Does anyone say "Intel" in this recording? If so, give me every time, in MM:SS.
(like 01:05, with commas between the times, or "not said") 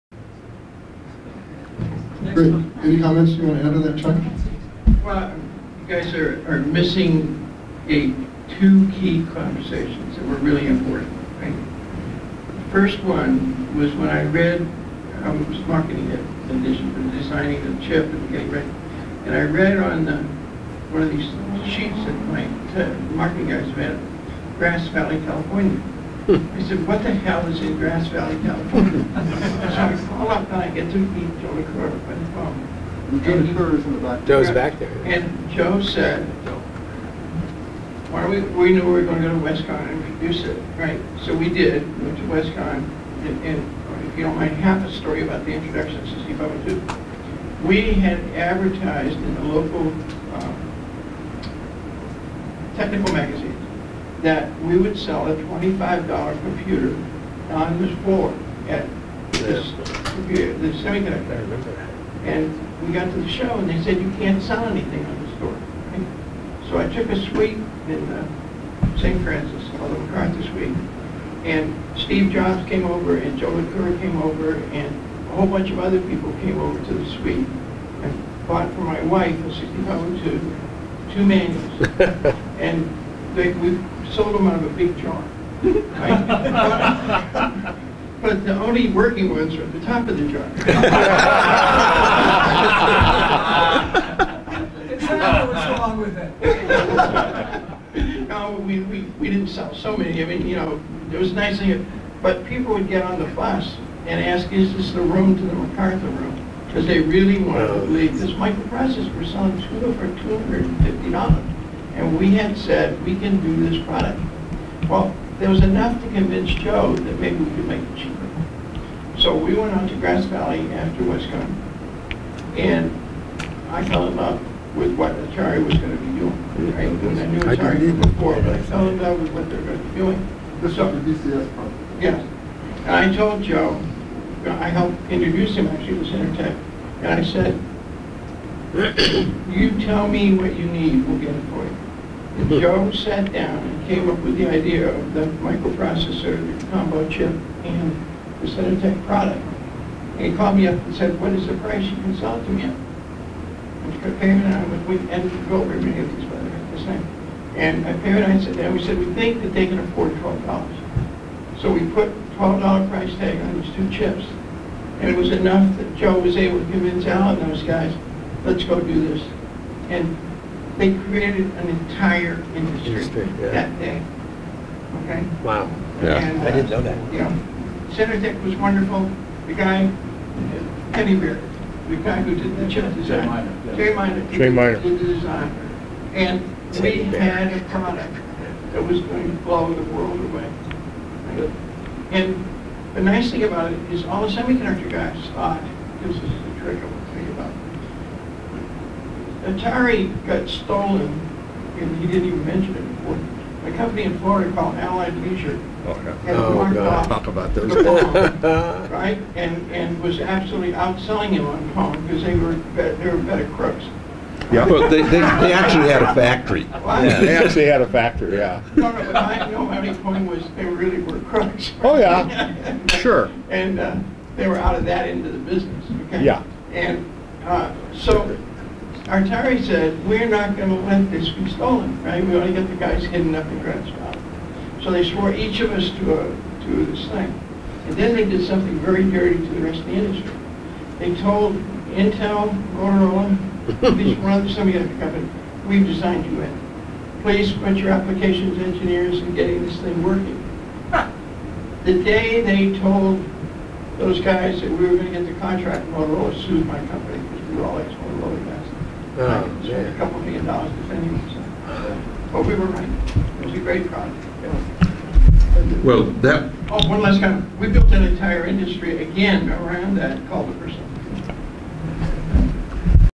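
04:01.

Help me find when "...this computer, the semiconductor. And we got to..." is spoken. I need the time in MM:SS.
00:59.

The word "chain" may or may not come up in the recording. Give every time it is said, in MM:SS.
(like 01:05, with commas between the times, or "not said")
not said.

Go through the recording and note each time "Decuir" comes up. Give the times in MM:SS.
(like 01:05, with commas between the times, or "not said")
00:31, 01:13.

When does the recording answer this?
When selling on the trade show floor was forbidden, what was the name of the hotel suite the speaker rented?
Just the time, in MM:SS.
01:09.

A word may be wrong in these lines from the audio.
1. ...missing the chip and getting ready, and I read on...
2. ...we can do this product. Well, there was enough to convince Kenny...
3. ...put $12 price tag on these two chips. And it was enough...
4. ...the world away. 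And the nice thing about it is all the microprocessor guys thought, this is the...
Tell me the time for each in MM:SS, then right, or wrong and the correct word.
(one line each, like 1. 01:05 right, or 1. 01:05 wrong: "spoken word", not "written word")
1. 00:17 wrong: "designing", not "missing"
2. 01:53 wrong: "Joe", not "Kenny"
3. 02:41 right
4. 03:09 wrong: "semiconductor", not "microprocessor".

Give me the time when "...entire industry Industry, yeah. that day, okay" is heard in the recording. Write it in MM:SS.
02:51.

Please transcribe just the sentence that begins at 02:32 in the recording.
I Pam and I was with many of these by way, the same.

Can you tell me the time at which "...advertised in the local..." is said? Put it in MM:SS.
00:48.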